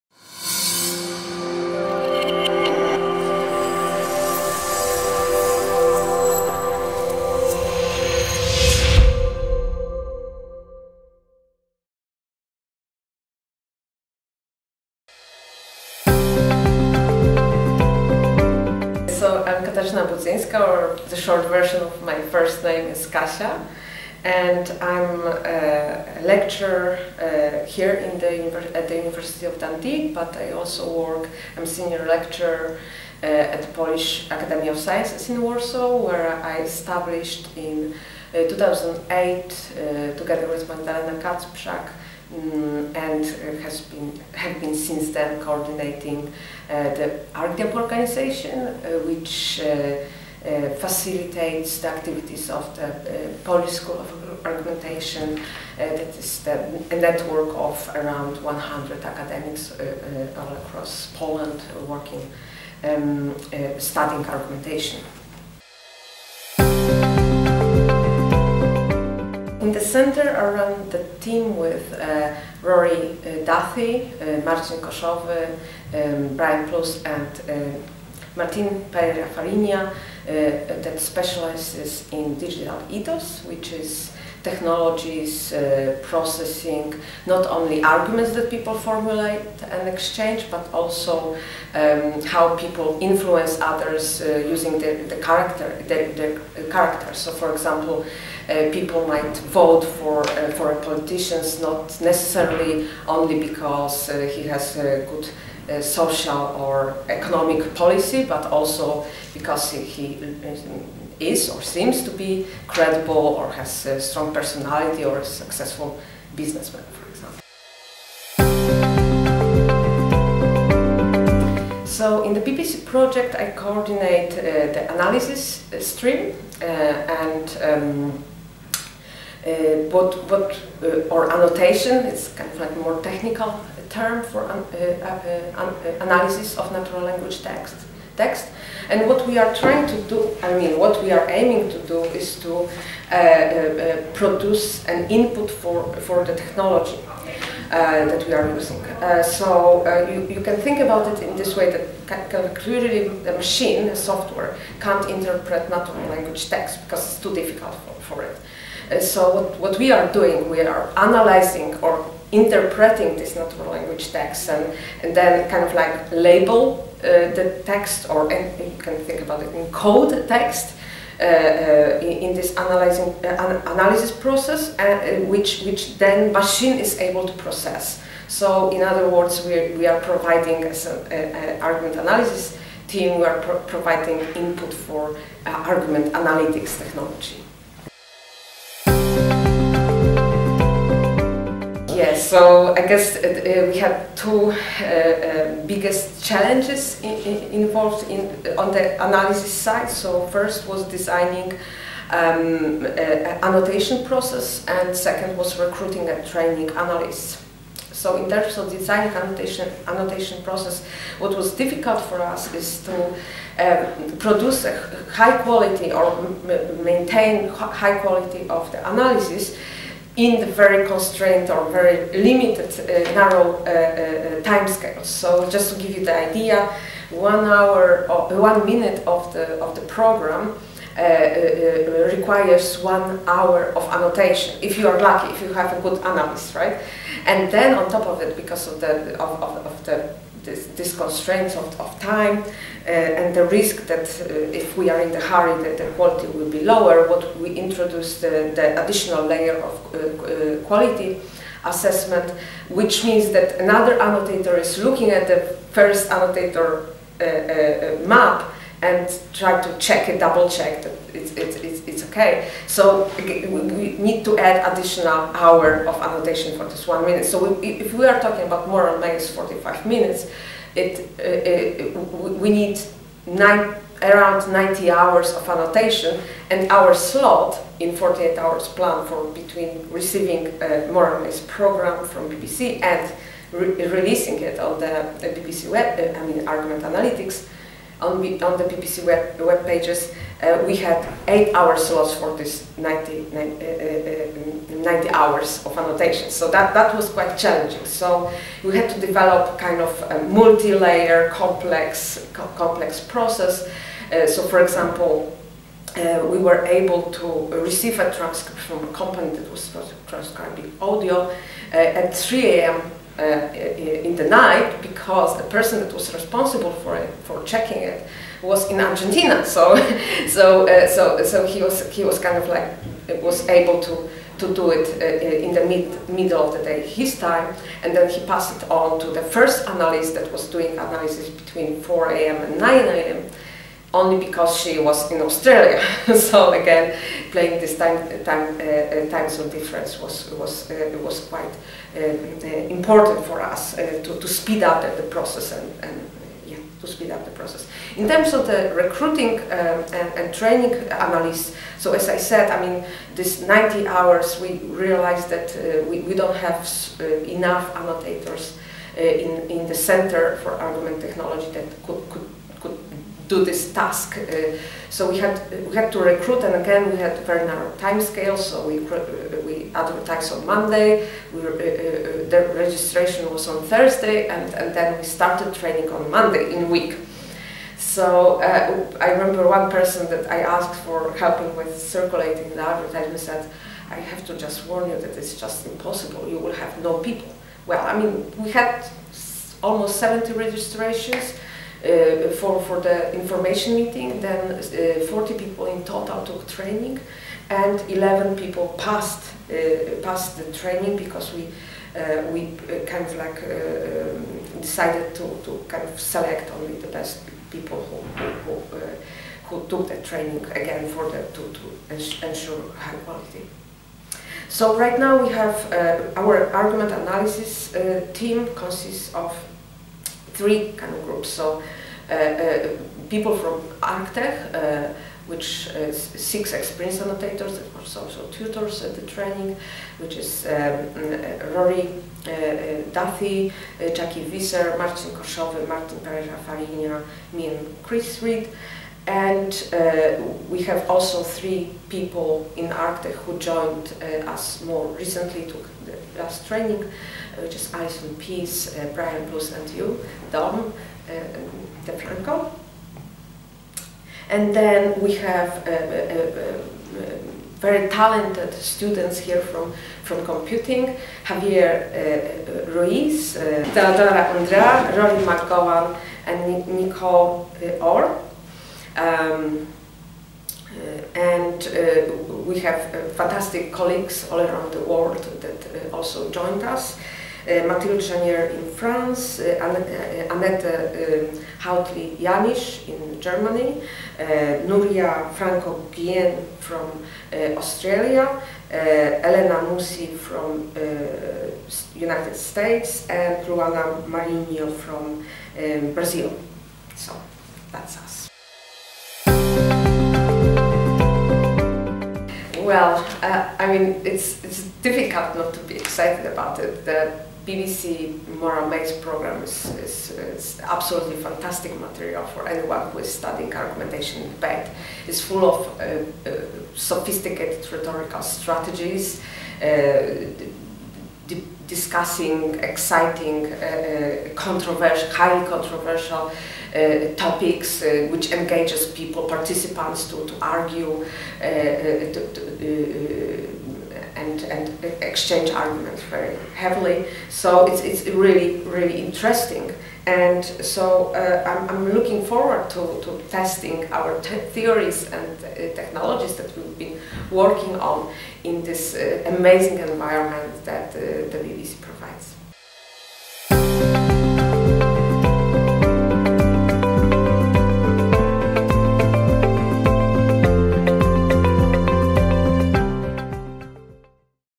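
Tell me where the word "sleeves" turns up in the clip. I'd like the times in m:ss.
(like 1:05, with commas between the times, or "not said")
not said.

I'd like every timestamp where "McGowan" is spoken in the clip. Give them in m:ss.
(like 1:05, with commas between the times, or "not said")
7:45.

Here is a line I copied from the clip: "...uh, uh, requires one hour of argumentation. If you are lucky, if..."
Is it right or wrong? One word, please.
wrong.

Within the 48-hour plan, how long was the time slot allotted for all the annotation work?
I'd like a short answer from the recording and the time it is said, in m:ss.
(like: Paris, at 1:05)
8 hours, at 4:51.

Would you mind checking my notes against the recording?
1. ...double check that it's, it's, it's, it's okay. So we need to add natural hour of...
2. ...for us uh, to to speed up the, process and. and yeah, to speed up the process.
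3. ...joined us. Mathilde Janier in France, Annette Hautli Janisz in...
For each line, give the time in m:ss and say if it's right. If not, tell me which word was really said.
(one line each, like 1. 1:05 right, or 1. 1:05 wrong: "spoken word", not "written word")
1. 4:20 wrong: "additional", not "natural"
2. 5:43 right
3. 7:56 right.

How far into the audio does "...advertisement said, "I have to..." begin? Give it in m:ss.
6:22.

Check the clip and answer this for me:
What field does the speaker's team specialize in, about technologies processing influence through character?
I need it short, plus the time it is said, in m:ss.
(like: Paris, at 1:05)
Digital ethos, at 1:22.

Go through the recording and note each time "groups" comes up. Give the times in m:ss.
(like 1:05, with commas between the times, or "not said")
7:01.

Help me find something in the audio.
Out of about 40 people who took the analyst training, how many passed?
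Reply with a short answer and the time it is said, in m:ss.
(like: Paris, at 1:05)
11, at 6:37.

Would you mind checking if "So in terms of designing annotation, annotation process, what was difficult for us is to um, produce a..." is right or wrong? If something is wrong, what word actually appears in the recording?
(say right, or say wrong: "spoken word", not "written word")
right.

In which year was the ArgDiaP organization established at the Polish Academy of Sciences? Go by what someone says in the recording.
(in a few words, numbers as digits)
2008.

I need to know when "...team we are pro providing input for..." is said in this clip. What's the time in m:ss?
3:02.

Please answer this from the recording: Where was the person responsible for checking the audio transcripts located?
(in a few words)
Argentina.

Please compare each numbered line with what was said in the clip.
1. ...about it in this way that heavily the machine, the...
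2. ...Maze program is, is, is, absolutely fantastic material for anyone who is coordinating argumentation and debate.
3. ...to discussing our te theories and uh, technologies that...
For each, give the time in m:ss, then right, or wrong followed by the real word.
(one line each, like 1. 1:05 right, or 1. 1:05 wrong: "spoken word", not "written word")
1. 2:30 wrong: "clearly", not "heavily"
2. 8:28 wrong: "studying", not "coordinating"
3. 9:03 wrong: "testing", not "discussing".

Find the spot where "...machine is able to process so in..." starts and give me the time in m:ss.
2:56.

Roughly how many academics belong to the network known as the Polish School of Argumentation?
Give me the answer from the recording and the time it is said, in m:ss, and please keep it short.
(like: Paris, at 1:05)
100, at 0:58.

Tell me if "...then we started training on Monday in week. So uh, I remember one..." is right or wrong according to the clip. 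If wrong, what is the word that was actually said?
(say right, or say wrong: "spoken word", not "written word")
right.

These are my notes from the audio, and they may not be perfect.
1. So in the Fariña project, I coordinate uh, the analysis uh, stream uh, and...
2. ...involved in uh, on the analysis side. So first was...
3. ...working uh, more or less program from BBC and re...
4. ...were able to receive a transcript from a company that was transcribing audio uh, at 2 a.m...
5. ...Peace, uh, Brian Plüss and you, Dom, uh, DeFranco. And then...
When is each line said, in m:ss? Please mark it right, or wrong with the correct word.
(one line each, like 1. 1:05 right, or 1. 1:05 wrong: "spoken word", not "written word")
1. 2:01 wrong: "BBC", not "Fariña"
2. 3:17 right
3. 4:39 wrong: "receiving", not "working"
4. 5:06 wrong: "3", not "2"
5. 7:28 right.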